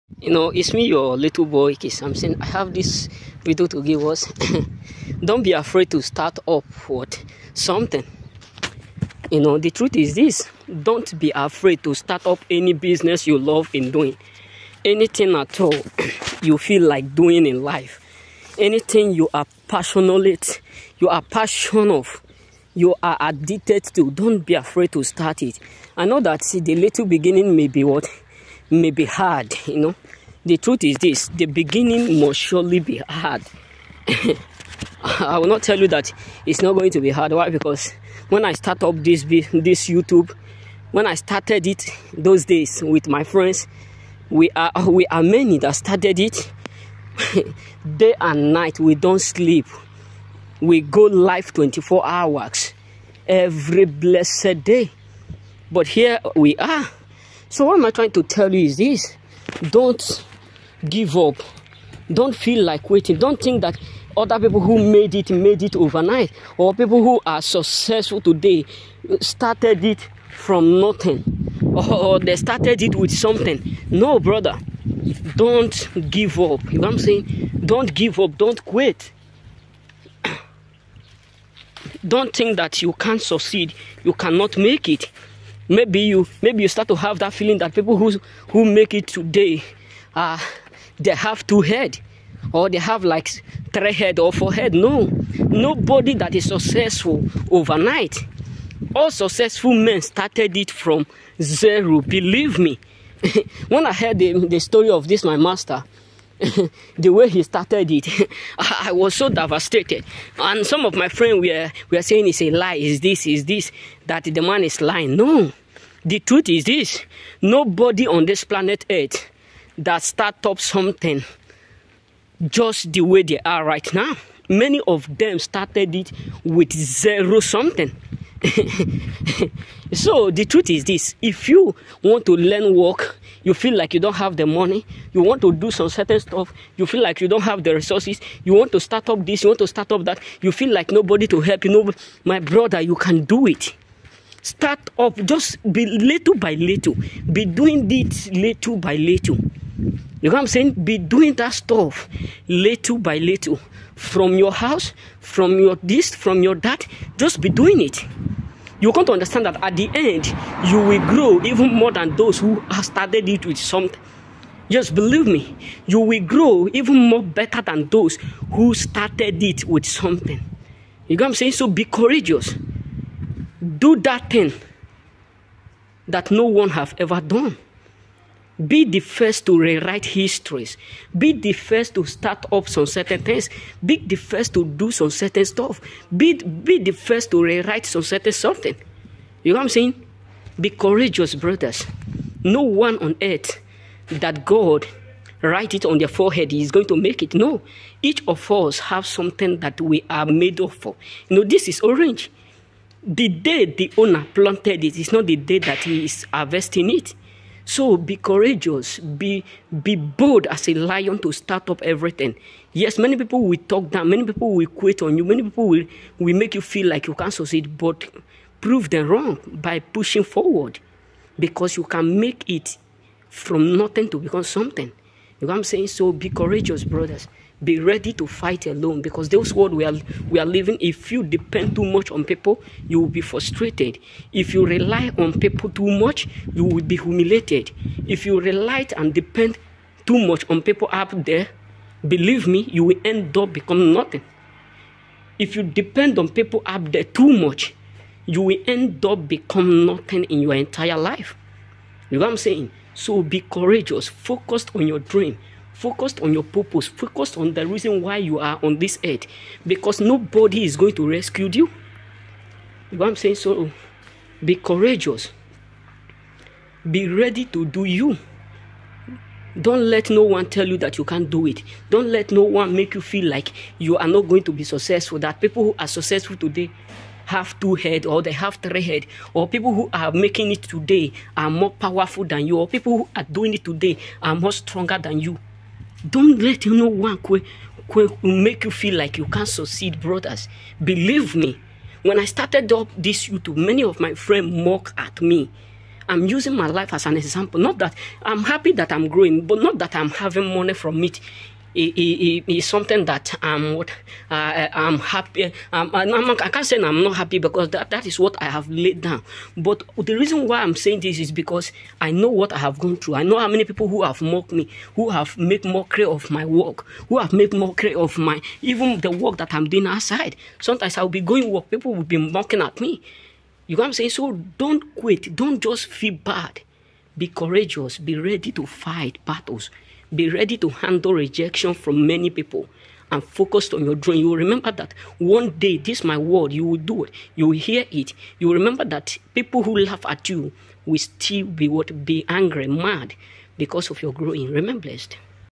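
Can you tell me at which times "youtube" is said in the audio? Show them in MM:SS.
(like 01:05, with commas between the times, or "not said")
00:39, 04:53.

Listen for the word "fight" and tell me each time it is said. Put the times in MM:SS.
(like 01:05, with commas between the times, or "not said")
03:48, 05:28.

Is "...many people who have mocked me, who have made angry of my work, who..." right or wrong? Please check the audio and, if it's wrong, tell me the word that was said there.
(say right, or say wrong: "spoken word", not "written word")
wrong: "mockery", not "angry".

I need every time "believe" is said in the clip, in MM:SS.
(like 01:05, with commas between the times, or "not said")
01:42, 02:44, 04:02, 04:50.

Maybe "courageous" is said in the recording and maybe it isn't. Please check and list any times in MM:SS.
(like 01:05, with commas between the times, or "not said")
02:51, 03:10, 03:28, 03:46, 04:13, 04:24, 05:27.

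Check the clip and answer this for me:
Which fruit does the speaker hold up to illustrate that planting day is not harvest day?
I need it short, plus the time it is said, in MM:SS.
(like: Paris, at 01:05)
Orange, at 03:21.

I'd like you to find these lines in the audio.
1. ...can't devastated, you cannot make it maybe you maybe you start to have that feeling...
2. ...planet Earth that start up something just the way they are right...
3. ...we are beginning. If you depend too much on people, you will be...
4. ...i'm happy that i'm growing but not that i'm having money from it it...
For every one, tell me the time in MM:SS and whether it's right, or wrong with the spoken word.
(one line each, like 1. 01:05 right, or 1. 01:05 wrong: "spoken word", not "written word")
1. 01:22 wrong: "succeed", not "devastated"
2. 01:58 right
3. 03:50 wrong: "living", not "beginning"
4. 04:58 right.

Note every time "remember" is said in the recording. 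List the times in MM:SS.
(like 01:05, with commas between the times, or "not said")
05:34, 05:38, 05:44.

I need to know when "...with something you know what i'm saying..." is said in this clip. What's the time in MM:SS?
02:49.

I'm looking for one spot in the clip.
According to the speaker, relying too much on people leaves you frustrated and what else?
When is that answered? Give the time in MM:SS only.
03:56.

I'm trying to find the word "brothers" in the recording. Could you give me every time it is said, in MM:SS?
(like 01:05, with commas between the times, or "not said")
01:14, 02:22, 03:11, 03:46, 04:49.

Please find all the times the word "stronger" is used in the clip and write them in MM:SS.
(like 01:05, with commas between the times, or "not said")
04:44.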